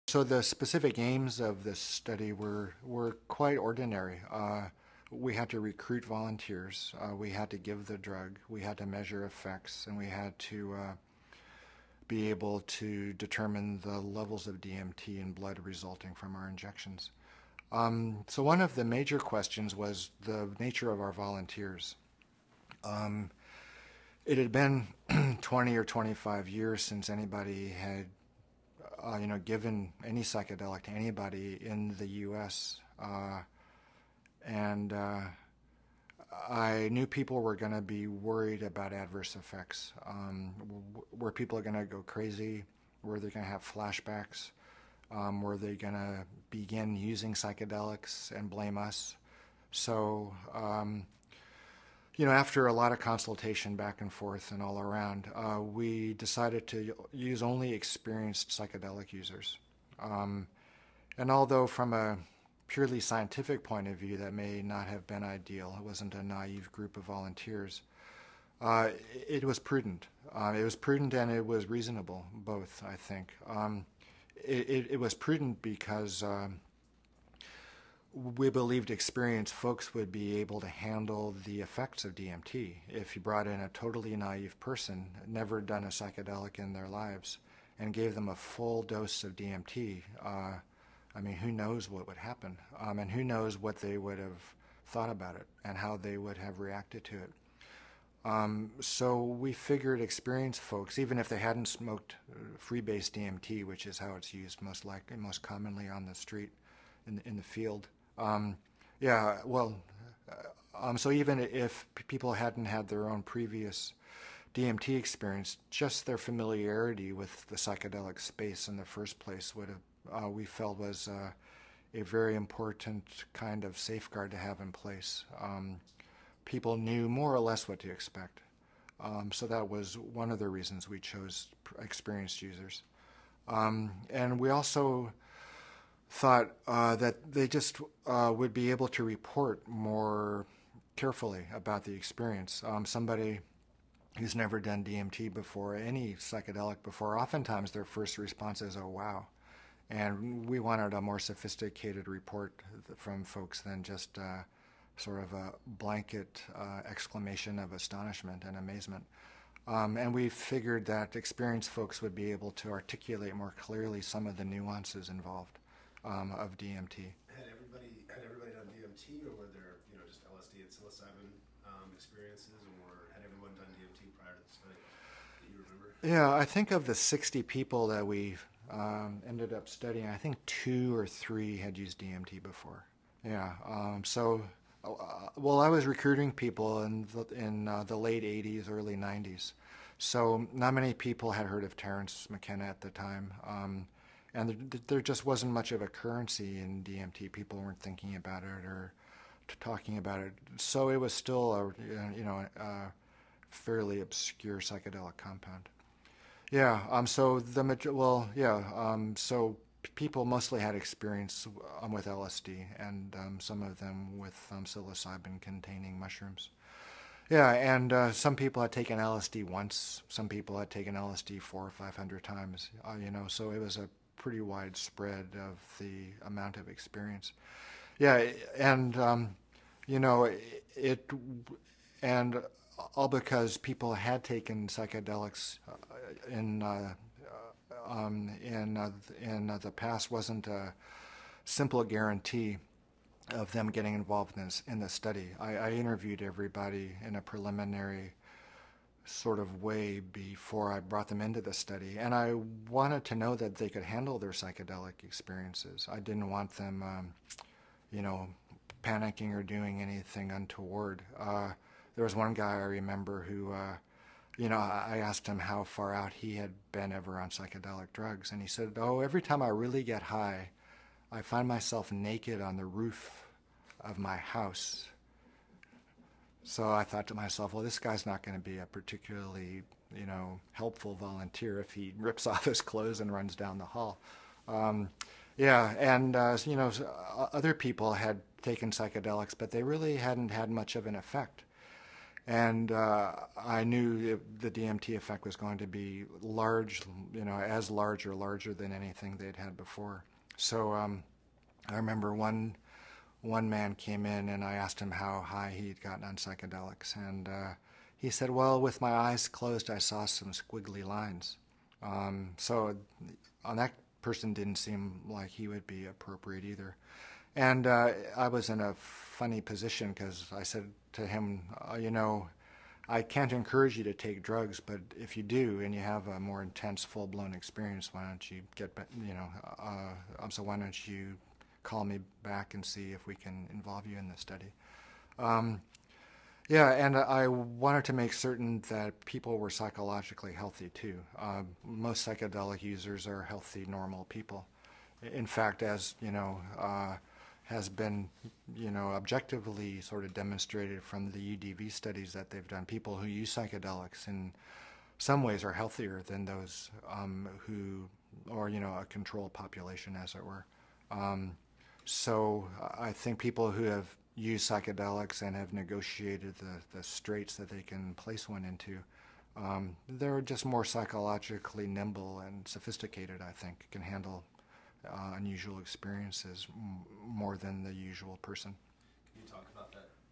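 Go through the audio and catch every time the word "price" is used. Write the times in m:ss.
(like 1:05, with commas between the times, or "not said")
not said.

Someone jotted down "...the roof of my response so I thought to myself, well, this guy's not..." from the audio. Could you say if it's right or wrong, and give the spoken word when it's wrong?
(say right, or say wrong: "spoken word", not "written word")
wrong: "house", not "response".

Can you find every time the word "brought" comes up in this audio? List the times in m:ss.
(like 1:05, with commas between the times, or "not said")
1:23, 4:10.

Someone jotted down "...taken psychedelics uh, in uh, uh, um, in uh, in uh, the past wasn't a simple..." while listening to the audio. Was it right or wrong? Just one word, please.
right.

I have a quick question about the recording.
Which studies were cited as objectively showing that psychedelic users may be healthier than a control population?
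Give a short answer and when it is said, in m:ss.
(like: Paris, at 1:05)
UDV studies, at 5:51.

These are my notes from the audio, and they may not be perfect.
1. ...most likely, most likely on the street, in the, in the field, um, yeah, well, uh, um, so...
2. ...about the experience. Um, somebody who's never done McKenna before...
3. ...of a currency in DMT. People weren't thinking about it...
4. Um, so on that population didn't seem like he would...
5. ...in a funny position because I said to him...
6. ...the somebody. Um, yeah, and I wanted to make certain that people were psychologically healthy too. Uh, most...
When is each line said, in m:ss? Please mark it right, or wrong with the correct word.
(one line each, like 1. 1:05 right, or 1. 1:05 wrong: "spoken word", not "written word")
1. 1:44 wrong: "commonly", not "likely"
2. 2:21 wrong: "DMT", not "McKenna"
3. 3:15 right
4. 5:11 wrong: "person", not "population"
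5. 5:18 right
6. 5:34 wrong: "study", not "somebody".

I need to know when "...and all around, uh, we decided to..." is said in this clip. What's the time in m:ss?
0:54.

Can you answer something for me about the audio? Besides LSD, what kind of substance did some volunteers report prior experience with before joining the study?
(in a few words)
psilocybin-containing mushrooms.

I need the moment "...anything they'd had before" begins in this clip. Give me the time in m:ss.
4:58.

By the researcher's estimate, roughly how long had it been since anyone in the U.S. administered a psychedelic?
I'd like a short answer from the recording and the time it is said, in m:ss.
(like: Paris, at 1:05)
20 or 25 years, at 0:25.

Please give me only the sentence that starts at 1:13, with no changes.
Um, it, it, it, was prudent because um, we believed experienced folks would be able to handle the effects of DMT.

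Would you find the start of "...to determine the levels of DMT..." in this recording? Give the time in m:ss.
0:12.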